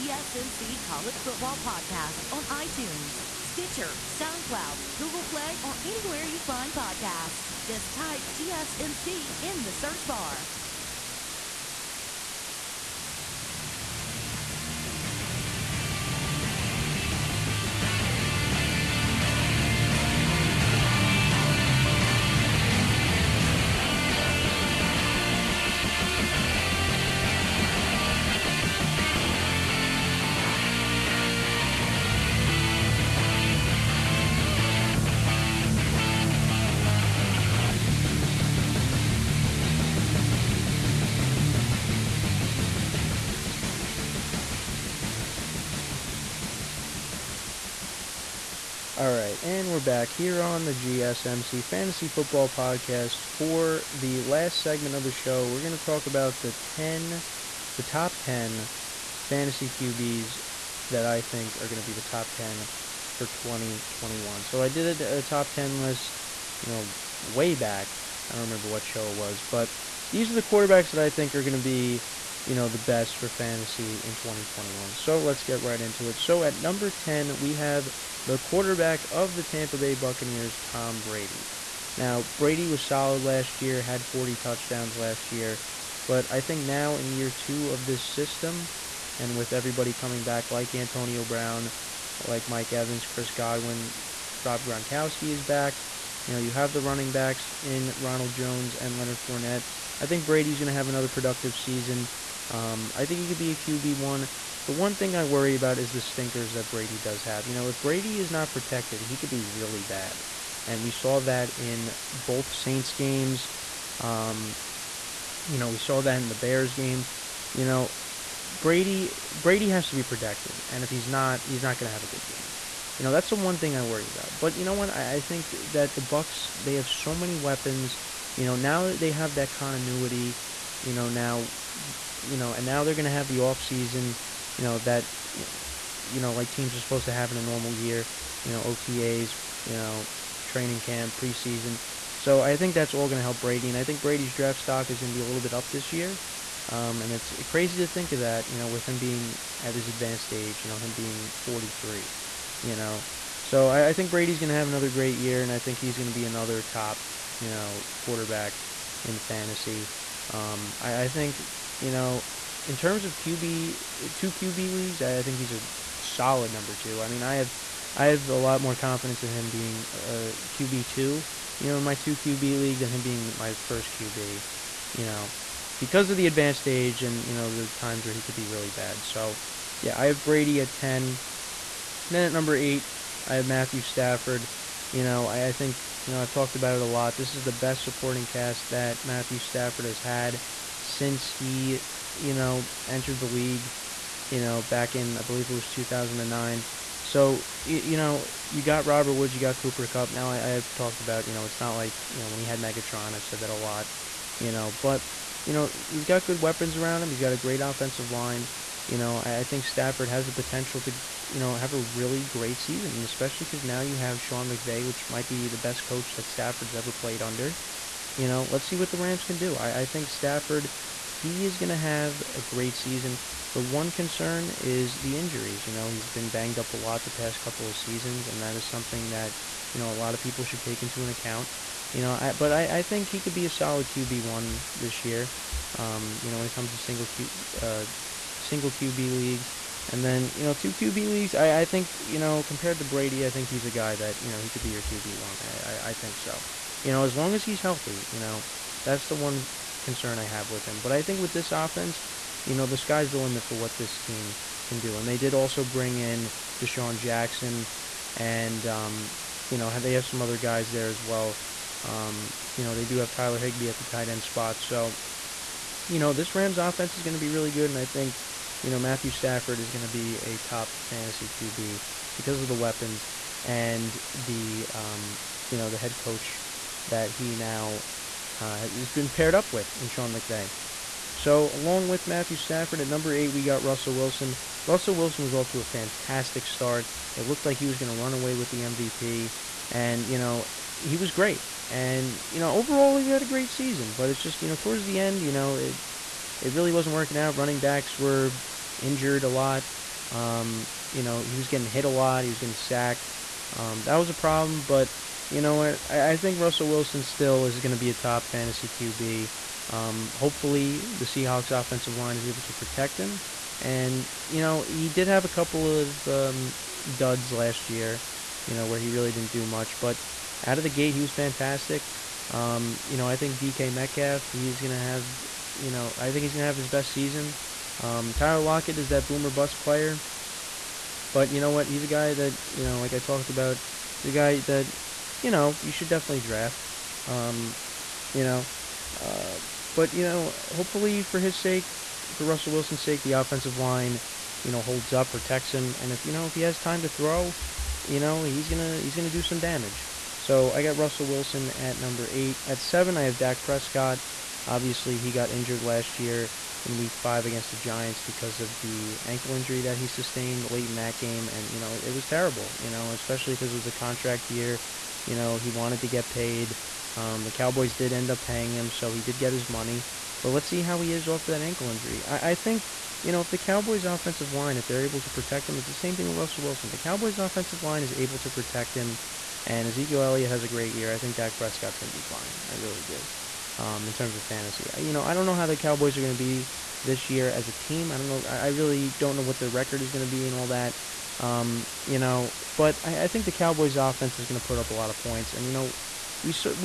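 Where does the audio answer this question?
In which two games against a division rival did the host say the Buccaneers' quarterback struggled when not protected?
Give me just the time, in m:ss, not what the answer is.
1:52.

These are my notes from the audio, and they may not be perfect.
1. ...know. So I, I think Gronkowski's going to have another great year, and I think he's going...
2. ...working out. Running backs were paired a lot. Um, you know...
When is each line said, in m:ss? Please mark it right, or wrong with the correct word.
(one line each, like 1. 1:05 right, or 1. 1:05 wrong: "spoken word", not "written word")
1. 2:32 wrong: "Brady", not "Gronkowski"
2. 4:56 wrong: "injured", not "paired".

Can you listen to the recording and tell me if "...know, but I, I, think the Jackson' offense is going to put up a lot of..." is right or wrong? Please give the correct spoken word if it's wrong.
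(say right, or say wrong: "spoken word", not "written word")
wrong: "Cowboys", not "Jackson".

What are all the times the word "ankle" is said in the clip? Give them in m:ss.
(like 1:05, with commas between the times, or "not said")
5:59, 6:11.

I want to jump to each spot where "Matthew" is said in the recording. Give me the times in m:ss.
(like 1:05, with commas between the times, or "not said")
3:03, 3:09, 4:28, 4:42.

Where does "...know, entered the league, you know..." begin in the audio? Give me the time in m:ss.
3:12.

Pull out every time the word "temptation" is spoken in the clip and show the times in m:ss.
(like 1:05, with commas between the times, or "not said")
not said.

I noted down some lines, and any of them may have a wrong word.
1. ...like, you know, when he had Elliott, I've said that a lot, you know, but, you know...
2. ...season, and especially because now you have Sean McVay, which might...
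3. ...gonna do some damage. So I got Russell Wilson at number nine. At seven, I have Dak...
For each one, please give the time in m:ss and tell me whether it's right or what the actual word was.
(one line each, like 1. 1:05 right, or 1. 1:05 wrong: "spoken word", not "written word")
1. 3:21 wrong: "Megatron", not "Elliott"
2. 3:32 right
3. 5:48 wrong: "eight", not "nine".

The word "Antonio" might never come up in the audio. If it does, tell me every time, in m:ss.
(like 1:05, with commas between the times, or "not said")
1:30.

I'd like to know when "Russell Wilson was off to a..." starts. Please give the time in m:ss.
4:44.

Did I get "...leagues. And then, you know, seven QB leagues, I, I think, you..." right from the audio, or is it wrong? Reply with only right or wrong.
wrong.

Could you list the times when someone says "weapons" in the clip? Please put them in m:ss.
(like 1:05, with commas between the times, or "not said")
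2:07, 3:26, 4:32.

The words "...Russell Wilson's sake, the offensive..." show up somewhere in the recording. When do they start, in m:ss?
5:42.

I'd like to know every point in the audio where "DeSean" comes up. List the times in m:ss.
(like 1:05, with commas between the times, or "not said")
4:16.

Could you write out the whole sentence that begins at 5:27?
Um, Tyler Lockett is that boomer bust player.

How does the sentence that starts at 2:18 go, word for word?
You know OTAs, you know training camp, preseason.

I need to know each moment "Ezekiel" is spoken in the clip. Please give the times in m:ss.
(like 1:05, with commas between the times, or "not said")
6:19.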